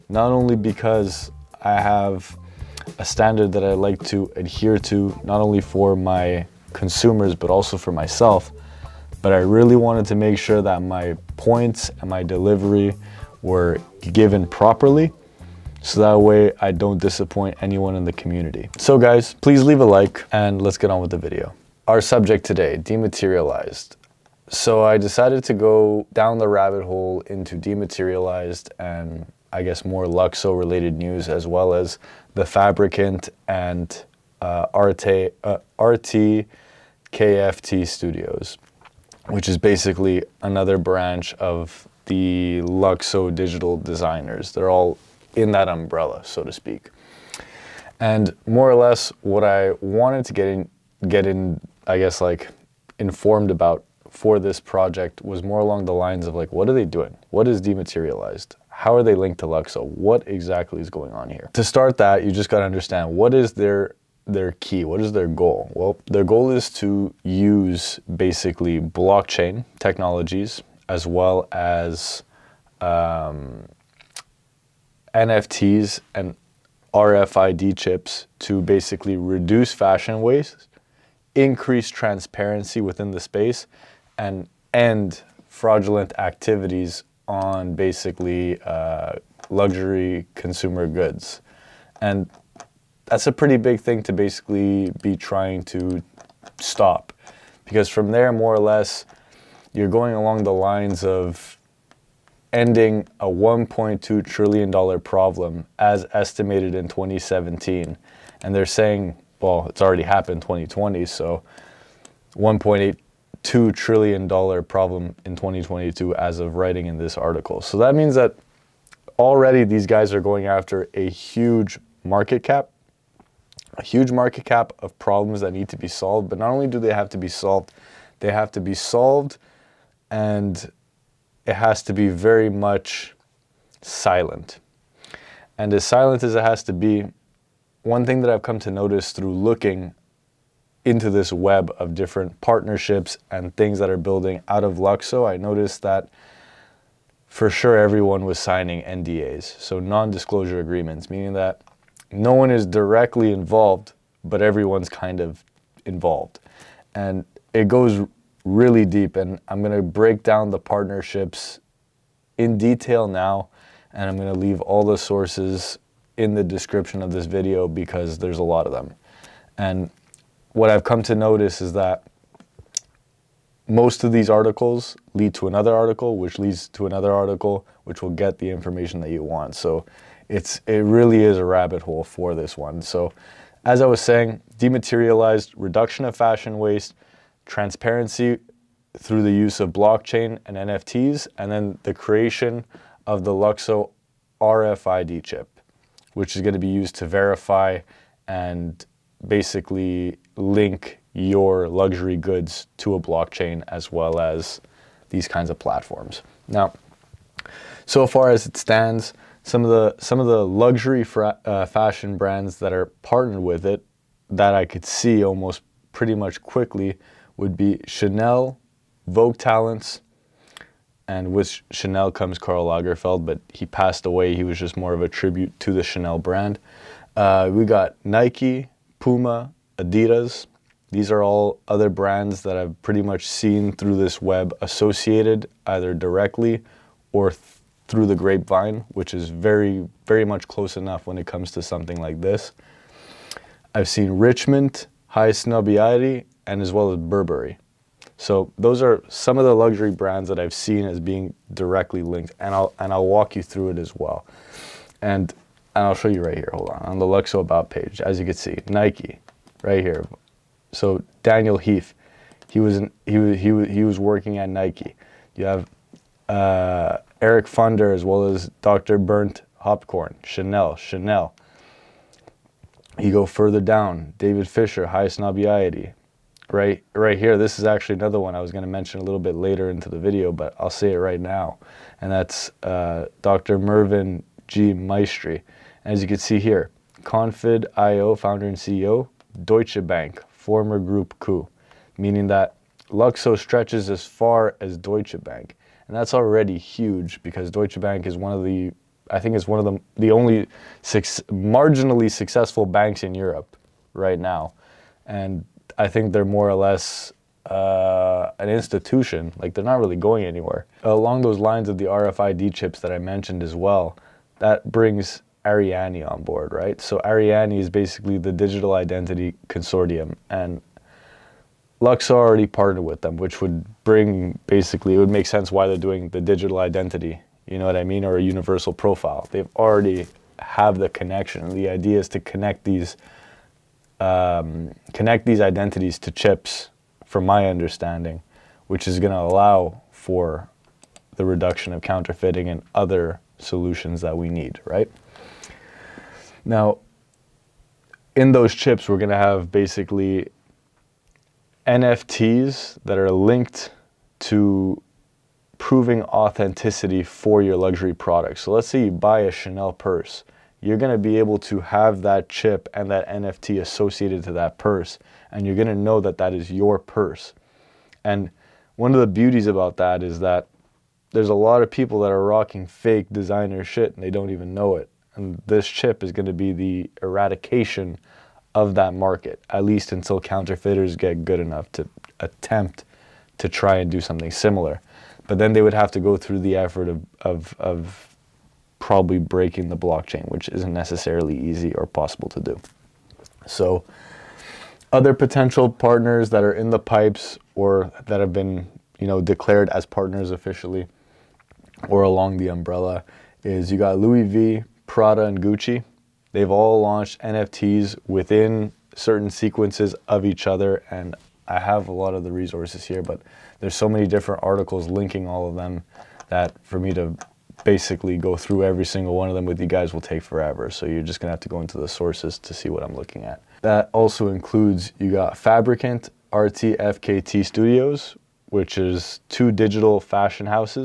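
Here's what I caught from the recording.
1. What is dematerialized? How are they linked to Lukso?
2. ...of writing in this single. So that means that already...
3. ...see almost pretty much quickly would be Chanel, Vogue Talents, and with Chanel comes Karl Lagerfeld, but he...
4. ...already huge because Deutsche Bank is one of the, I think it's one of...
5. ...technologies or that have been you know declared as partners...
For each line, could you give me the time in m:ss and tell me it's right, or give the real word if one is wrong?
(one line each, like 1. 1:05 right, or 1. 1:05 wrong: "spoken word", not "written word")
1. 0:57 right
2. 1:56 wrong: "article", not "single"
3. 3:34 right
4. 4:56 right
5. 6:36 wrong: "pipes", not "technologies".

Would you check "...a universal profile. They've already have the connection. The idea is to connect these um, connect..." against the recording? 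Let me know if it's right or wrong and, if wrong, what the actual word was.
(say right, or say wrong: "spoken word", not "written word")
right.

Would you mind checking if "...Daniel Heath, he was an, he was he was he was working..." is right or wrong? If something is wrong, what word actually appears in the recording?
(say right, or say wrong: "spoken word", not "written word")
right.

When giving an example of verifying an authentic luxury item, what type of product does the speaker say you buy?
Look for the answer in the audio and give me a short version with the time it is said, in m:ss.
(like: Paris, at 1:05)
Chanel purse, at 5:59.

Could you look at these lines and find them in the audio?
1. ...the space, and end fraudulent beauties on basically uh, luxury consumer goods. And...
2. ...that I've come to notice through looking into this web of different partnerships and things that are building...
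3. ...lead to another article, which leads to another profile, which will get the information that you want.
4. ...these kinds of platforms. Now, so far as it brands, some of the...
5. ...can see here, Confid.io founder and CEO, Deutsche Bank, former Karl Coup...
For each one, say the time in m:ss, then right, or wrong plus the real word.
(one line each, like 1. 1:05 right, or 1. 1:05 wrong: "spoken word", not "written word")
1. 1:23 wrong: "activities", not "beauties"
2. 2:18 right
3. 2:55 wrong: "article", not "profile"
4. 3:25 wrong: "stands", not "brands"
5. 4:46 wrong: "Group", not "Karl".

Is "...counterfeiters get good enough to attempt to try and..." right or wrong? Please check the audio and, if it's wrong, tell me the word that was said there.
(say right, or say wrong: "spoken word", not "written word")
right.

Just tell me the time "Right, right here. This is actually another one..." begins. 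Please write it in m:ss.
4:36.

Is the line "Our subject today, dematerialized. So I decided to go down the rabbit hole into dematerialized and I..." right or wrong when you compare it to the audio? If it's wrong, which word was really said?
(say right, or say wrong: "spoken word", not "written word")
right.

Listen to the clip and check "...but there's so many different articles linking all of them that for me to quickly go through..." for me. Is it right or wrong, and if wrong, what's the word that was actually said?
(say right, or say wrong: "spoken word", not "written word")
wrong: "basically", not "quickly".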